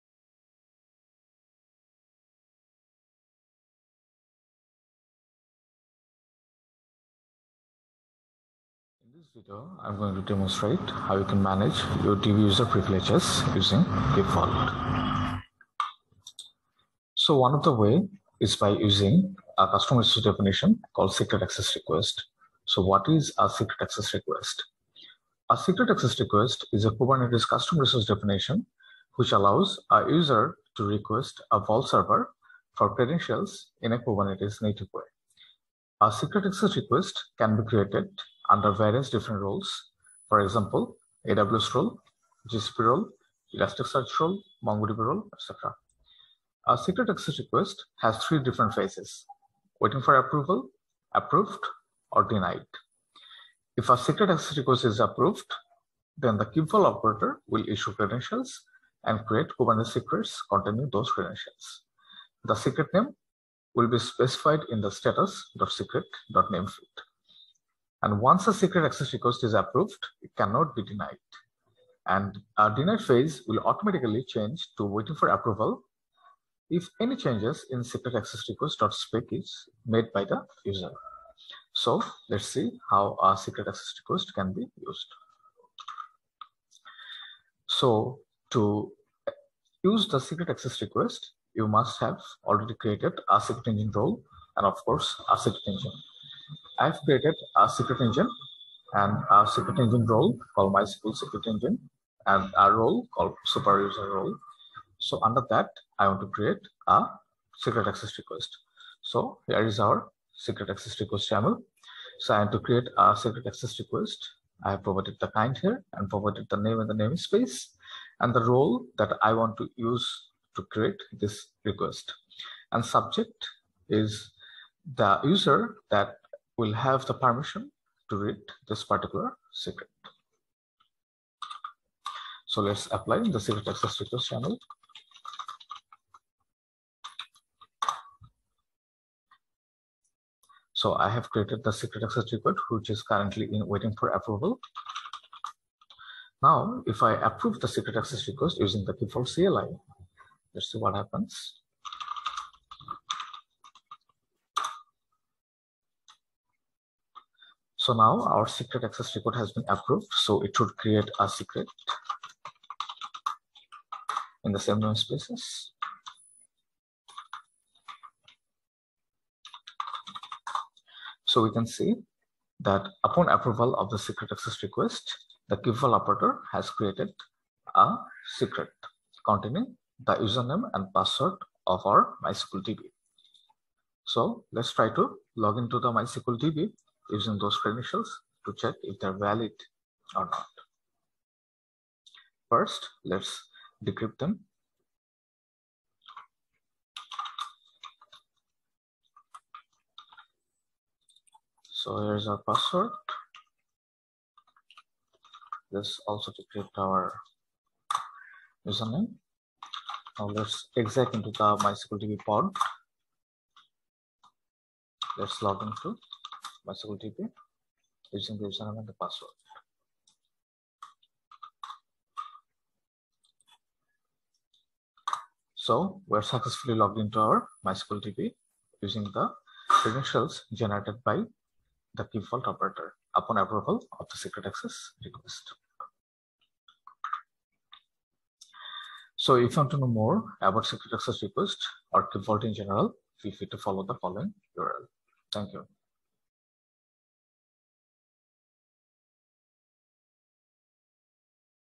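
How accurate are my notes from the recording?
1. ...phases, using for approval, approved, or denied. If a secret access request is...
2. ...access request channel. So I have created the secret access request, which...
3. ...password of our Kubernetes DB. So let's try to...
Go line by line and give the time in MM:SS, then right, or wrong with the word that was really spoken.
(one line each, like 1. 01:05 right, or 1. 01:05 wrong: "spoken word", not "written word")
1. 00:48 wrong: "waiting", not "using"
2. 02:13 right
3. 03:00 wrong: "MySQL", not "Kubernetes".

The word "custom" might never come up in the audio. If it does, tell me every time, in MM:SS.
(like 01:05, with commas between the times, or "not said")
00:19, 00:27.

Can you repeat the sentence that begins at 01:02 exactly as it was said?
The secret name will be specified in the status.secret.name field.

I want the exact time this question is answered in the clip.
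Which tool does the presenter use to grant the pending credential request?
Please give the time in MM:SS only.
02:28.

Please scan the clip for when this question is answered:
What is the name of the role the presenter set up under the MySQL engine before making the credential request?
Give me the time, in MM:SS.
01:43.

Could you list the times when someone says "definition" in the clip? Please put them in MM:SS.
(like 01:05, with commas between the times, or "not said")
00:20, 00:28.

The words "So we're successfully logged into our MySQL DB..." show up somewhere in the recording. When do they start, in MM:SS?
03:45.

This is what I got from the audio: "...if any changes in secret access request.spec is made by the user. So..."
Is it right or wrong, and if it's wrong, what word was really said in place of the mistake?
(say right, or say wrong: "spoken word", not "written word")
right.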